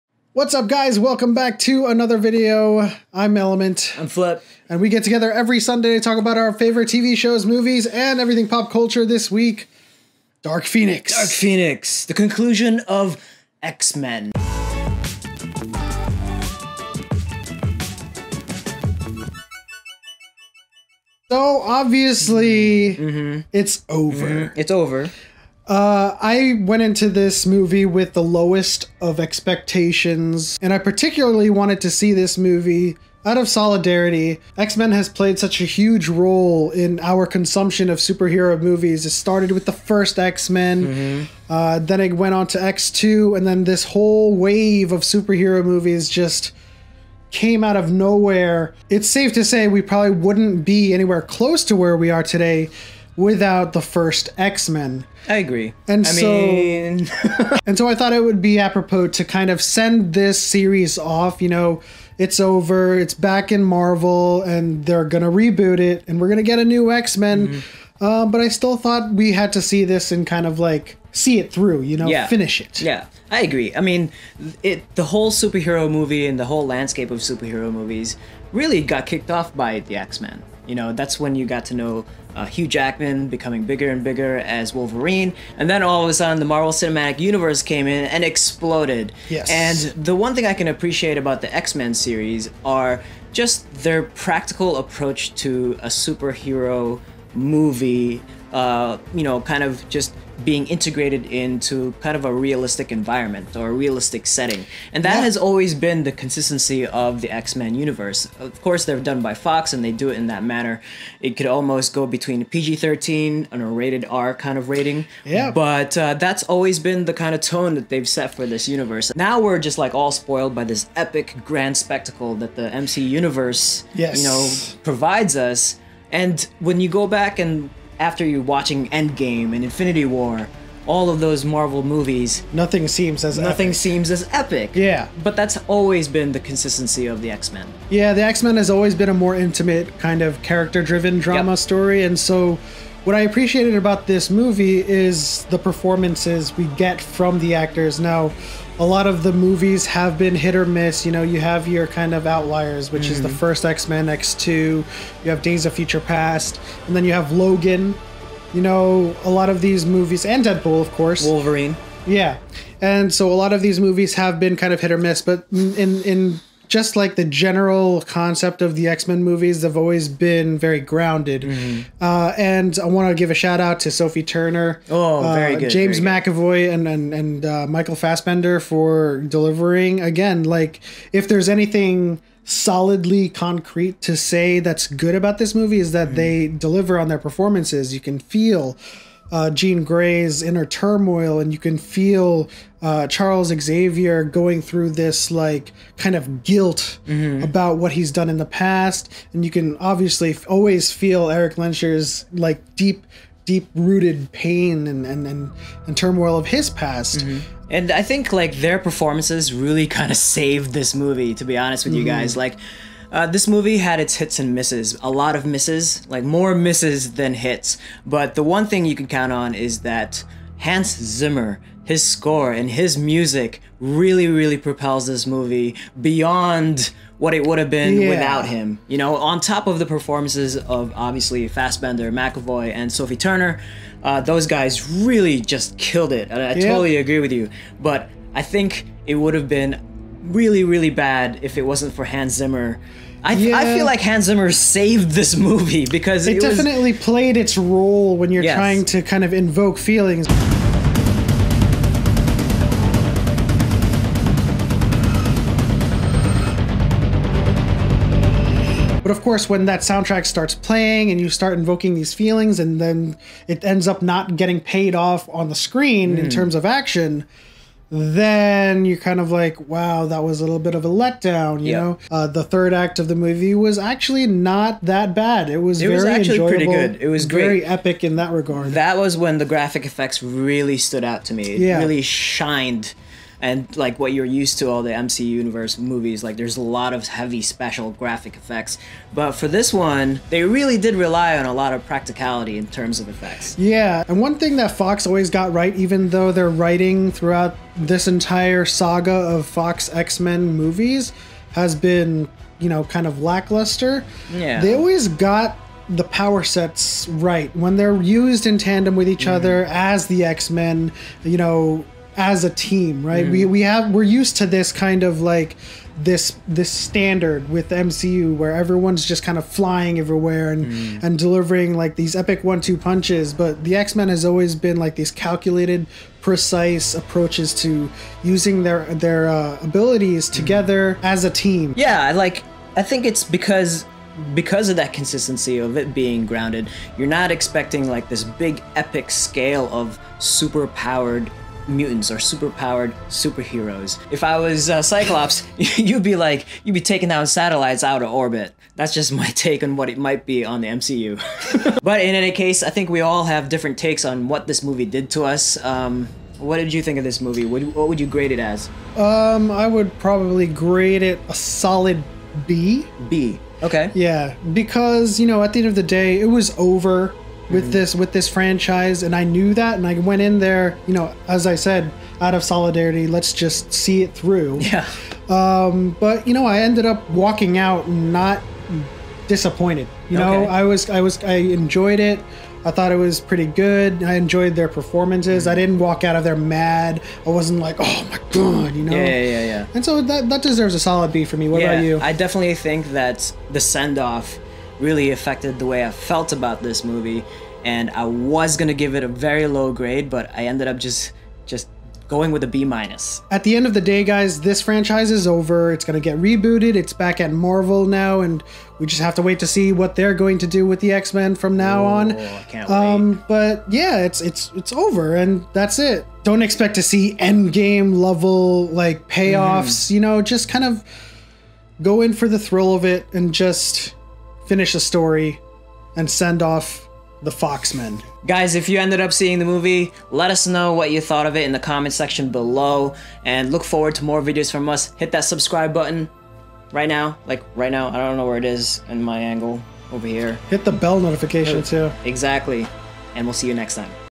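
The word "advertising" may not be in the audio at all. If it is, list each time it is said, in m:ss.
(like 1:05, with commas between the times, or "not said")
not said.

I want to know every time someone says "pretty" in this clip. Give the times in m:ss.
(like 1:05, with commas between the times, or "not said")
4:36, 6:23.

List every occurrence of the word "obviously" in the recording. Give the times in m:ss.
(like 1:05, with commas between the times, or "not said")
0:21, 3:19, 3:50.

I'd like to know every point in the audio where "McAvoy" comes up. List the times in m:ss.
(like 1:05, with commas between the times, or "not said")
2:56, 3:52.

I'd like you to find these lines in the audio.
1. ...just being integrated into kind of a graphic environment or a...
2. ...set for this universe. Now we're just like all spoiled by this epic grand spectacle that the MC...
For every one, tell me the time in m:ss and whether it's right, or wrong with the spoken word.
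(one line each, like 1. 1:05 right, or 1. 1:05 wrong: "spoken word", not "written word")
1. 1:39 wrong: "realistic", not "graphic"
2. 1:58 right.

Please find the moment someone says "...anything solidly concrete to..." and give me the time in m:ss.
3:01.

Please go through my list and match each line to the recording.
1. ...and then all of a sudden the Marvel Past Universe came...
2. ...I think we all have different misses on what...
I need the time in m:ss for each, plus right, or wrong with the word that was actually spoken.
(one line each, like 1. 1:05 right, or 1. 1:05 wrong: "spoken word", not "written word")
1. 1:25 wrong: "Cinematic", not "Past"
2. 5:52 wrong: "takes", not "misses".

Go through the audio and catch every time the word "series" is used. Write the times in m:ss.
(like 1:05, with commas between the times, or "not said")
1:00, 1:31.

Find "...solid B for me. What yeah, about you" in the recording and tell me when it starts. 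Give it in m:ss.
6:30.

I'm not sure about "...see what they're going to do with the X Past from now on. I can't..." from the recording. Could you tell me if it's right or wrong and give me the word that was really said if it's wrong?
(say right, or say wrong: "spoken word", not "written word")
wrong: "Men", not "Past".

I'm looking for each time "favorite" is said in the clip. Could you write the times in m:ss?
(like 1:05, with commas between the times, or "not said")
0:06.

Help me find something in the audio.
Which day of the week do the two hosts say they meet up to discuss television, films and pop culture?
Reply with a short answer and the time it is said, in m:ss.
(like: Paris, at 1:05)
Sunday, at 0:05.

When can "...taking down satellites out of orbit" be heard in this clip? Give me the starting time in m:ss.
5:46.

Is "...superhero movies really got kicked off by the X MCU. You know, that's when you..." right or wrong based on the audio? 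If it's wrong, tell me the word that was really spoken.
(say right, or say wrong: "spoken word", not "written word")
wrong: "Men", not "MCU".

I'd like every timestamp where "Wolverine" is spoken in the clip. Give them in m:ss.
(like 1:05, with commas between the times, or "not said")
1:24, 2:41.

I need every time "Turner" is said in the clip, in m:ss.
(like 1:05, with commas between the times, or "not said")
2:54, 3:53.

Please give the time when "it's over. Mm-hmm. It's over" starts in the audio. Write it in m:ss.
0:23.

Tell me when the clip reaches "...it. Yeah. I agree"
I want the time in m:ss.
1:12.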